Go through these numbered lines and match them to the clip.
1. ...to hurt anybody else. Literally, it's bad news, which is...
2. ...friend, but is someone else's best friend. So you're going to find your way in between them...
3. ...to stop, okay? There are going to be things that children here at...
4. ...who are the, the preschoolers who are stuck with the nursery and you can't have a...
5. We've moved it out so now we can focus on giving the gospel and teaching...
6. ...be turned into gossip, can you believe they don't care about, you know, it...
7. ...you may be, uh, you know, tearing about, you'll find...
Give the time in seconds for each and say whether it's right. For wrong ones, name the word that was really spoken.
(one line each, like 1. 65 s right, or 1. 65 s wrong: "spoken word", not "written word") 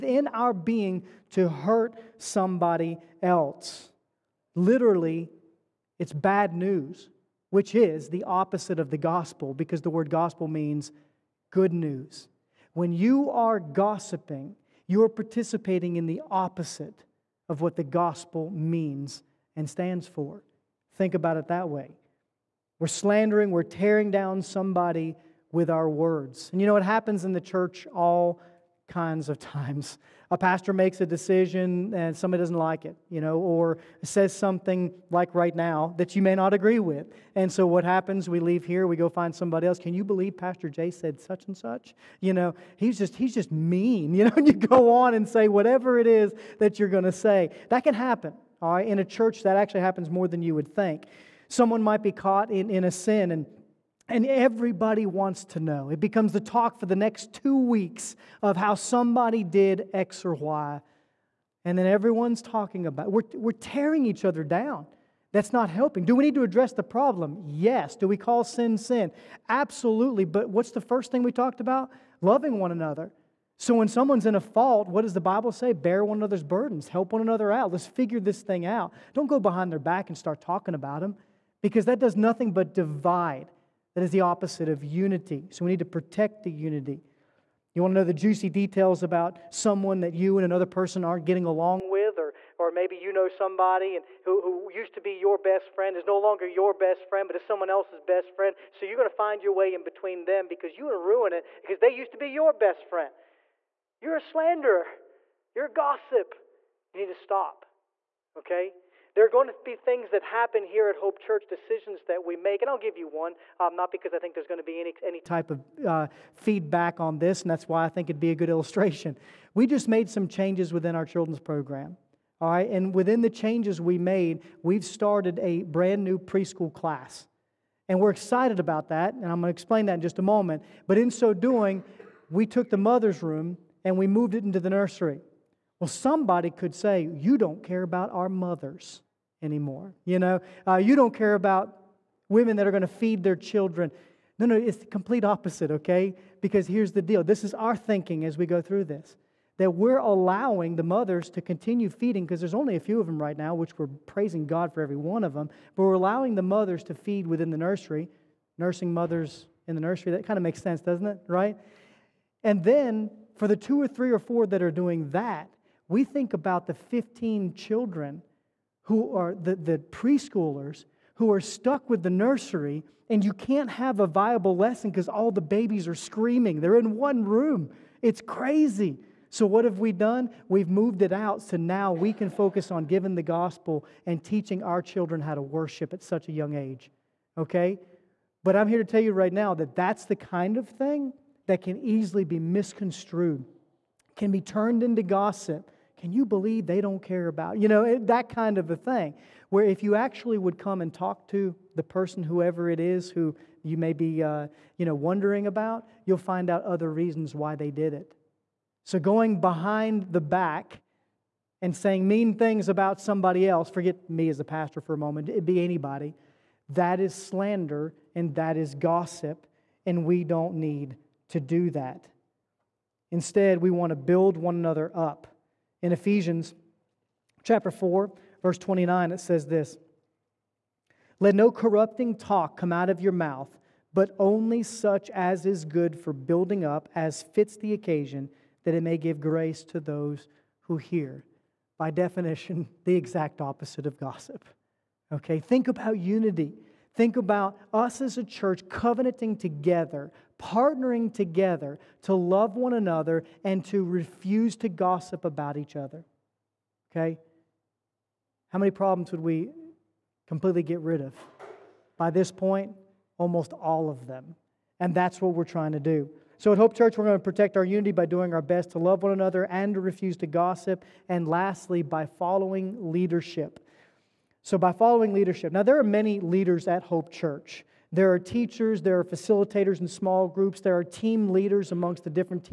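1. 1 s wrong: "somebody", not "anybody"
2. 97 s right
3. 107 s wrong: "happen", not "children"
4. 168 s right
5. 180 s right
6. 194 s right
7. 203 s wrong: "wondering", not "tearing".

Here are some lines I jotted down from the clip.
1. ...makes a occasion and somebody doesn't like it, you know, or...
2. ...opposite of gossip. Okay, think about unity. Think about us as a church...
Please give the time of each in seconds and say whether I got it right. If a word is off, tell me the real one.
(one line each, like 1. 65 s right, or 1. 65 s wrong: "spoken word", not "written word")
1. 30 s wrong: "decision", not "occasion"
2. 243 s right.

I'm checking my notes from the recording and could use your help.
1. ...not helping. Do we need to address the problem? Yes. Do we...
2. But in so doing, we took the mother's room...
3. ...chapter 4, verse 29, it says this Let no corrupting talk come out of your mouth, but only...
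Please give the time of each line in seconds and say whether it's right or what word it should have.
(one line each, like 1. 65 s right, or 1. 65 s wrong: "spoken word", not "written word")
1. 65 s right
2. 130 s right
3. 227 s right.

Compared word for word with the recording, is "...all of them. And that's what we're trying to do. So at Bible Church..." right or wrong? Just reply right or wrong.
wrong.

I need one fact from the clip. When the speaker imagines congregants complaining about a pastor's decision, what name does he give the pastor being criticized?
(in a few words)
Pastor Jay.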